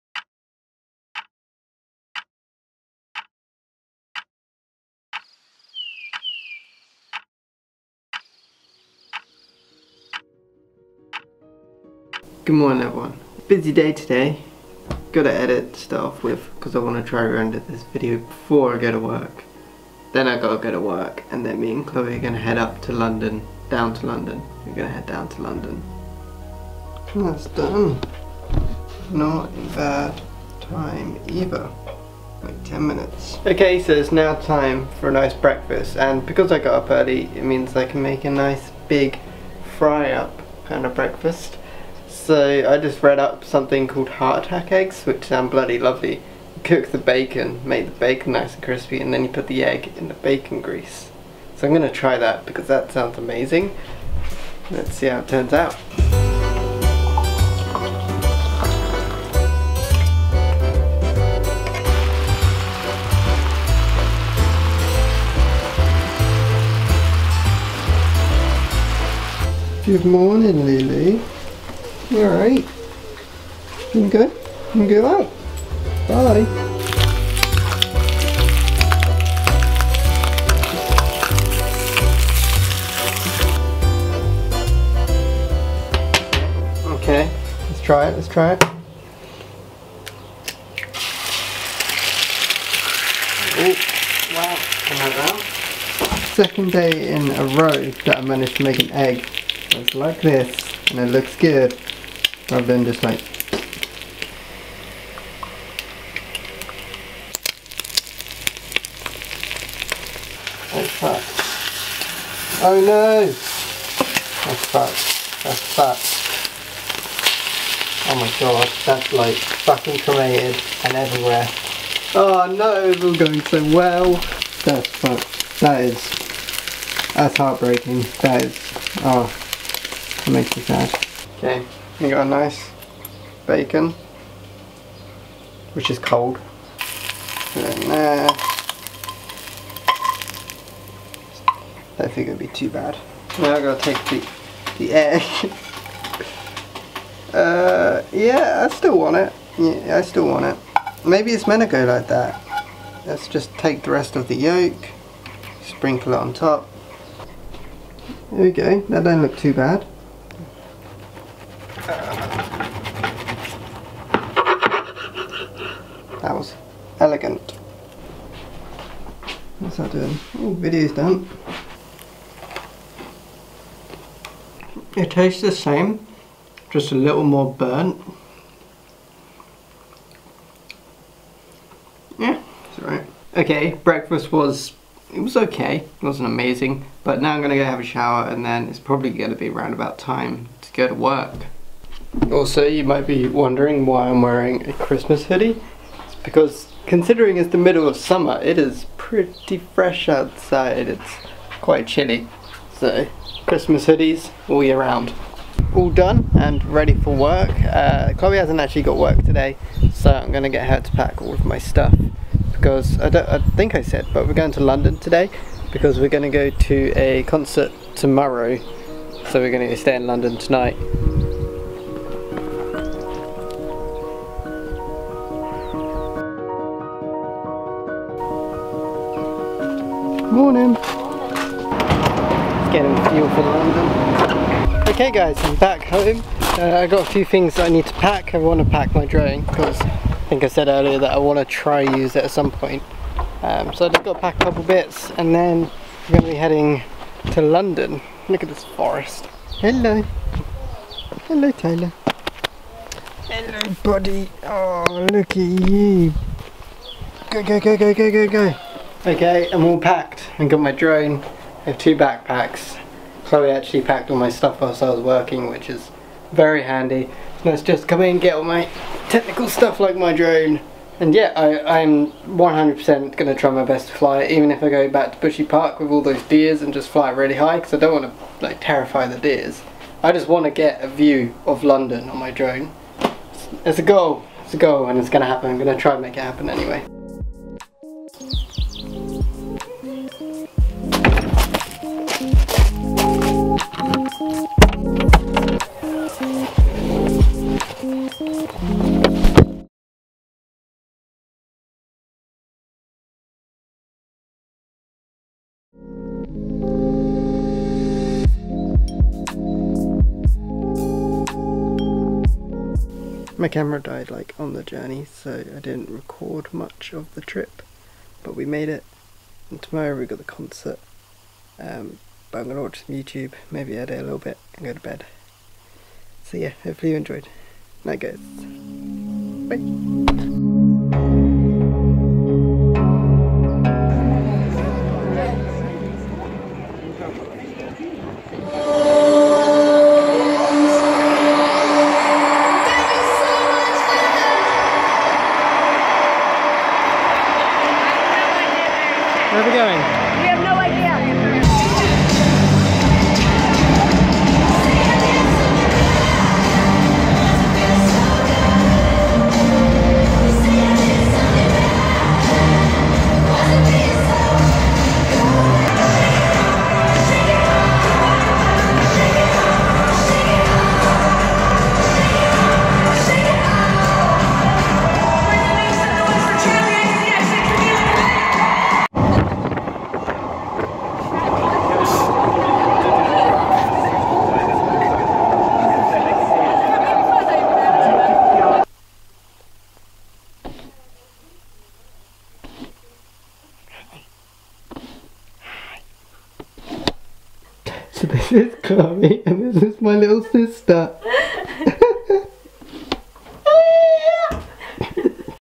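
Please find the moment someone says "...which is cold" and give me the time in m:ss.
2:15.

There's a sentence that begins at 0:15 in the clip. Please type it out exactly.
Gotta edit stuff with because I want to try render this video before I go to work.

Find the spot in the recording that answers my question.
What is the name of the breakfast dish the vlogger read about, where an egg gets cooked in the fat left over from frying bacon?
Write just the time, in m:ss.
0:44.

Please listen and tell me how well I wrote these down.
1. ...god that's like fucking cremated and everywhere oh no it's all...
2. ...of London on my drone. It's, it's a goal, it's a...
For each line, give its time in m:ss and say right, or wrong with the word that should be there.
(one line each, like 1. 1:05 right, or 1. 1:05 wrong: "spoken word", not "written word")
1. 1:58 right
2. 4:41 right.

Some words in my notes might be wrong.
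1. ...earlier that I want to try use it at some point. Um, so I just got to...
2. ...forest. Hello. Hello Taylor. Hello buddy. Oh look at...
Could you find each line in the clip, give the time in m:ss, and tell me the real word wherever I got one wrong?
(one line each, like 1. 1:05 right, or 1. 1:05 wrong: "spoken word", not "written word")
1. 4:00 right
2. 4:08 right.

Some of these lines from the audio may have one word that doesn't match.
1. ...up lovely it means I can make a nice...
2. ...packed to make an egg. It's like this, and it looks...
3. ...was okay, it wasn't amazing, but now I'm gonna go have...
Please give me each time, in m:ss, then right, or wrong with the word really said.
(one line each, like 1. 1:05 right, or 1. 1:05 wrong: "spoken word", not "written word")
1. 0:36 wrong: "early", not "lovely"
2. 1:38 wrong: "managed", not "packed"
3. 3:05 right.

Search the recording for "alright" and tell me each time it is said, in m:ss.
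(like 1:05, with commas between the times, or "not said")
1:12, 3:02.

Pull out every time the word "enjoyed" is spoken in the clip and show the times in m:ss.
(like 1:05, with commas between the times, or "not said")
5:26.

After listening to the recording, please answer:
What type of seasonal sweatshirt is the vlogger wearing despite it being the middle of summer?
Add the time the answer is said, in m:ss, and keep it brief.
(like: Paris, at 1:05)
Christmas hoodie, at 3:14.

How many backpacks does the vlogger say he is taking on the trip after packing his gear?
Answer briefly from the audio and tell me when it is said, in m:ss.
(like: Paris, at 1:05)
2, at 4:21.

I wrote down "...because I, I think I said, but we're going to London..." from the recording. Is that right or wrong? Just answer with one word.
right.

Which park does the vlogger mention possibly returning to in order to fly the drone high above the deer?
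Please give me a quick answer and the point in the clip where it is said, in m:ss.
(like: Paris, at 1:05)
Bushy Park, at 4:35.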